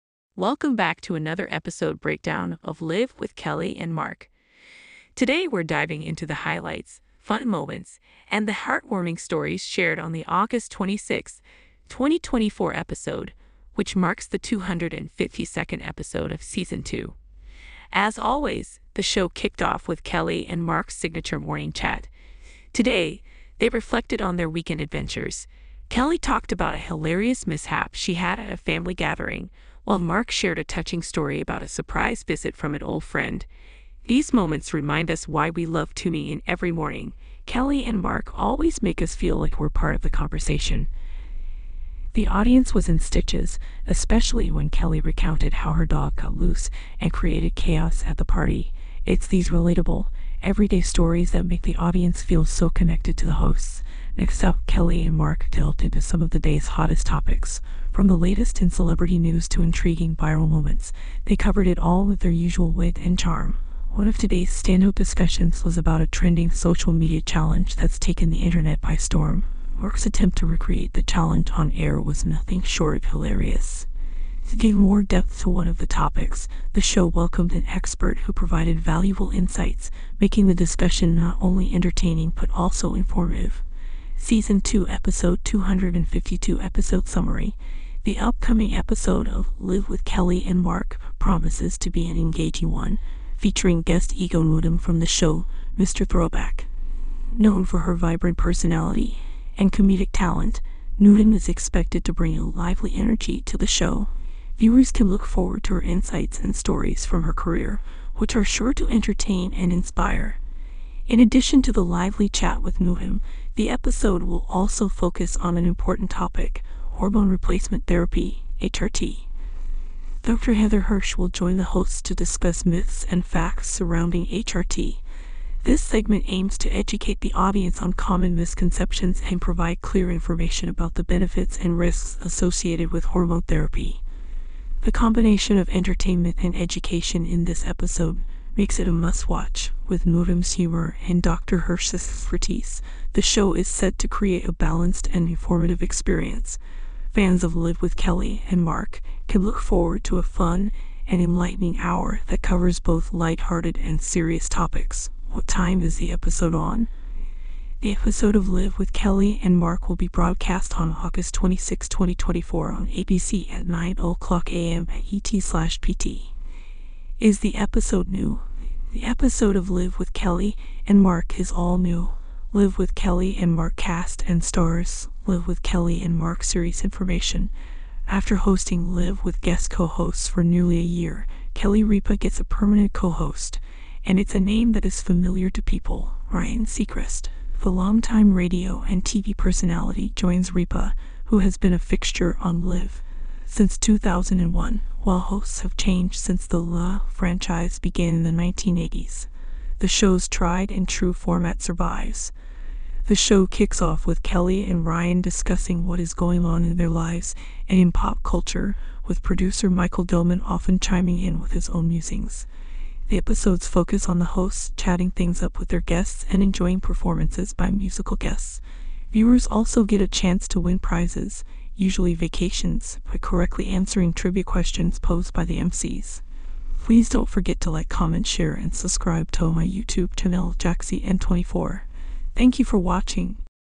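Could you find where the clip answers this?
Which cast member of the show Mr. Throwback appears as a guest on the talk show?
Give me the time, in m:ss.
1:34.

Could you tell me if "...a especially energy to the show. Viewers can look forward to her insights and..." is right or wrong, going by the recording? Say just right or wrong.
wrong.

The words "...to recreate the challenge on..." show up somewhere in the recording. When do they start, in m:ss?
1:10.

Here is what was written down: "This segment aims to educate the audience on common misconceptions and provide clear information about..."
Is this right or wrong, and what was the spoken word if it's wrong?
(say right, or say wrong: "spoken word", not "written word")
right.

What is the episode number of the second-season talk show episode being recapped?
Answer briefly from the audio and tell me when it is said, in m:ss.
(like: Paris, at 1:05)
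252, at 0:14.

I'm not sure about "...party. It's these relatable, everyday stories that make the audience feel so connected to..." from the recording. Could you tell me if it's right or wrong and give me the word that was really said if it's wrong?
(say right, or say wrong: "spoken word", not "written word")
right.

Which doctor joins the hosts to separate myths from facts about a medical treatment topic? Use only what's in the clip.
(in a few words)
Dr. Heather Hirsch.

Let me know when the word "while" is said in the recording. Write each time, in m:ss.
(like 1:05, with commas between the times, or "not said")
0:29, 3:15.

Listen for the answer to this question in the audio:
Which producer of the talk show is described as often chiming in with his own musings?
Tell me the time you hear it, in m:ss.
3:29.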